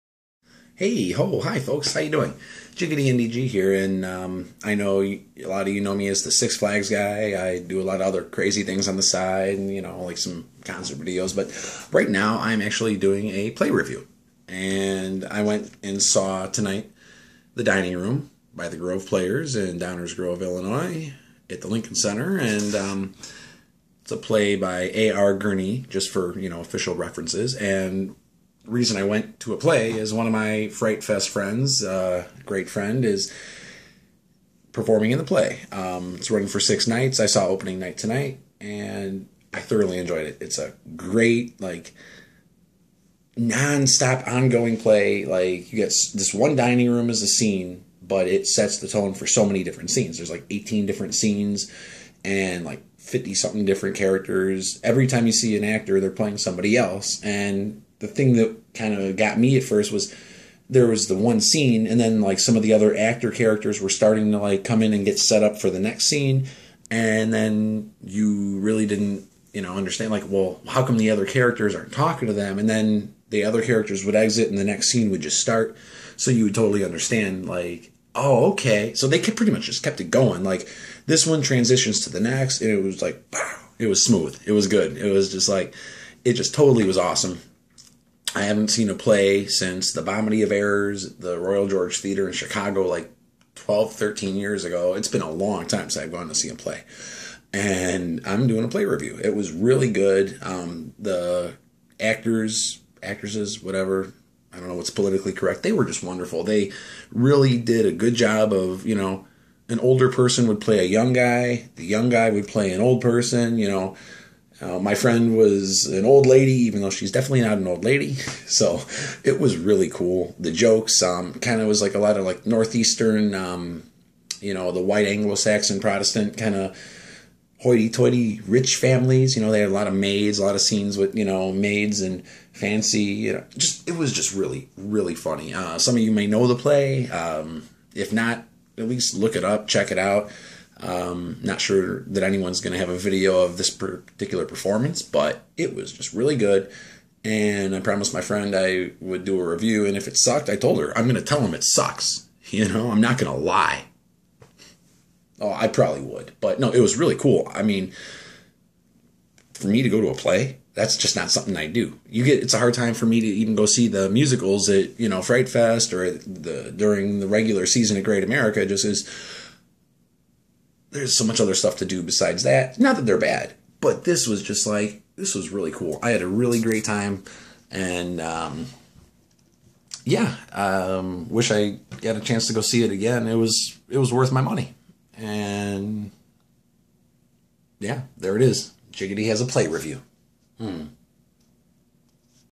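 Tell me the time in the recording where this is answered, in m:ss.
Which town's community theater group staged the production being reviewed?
0:19.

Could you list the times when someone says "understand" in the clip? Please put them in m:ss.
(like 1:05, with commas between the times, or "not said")
1:09, 1:16.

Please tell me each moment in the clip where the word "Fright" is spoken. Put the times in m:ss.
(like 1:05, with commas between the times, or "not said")
0:30, 2:45.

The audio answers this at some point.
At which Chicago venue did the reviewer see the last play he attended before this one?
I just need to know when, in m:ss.
1:31.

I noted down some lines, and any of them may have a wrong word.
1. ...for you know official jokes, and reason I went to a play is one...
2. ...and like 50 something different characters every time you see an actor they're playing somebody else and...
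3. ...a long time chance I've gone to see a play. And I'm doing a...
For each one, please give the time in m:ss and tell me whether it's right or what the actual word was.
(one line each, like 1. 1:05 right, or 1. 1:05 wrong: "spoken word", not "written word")
1. 0:26 wrong: "references", not "jokes"
2. 0:52 right
3. 1:35 wrong: "since", not "chance".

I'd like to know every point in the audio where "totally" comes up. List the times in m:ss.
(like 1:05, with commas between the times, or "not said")
1:16, 1:26.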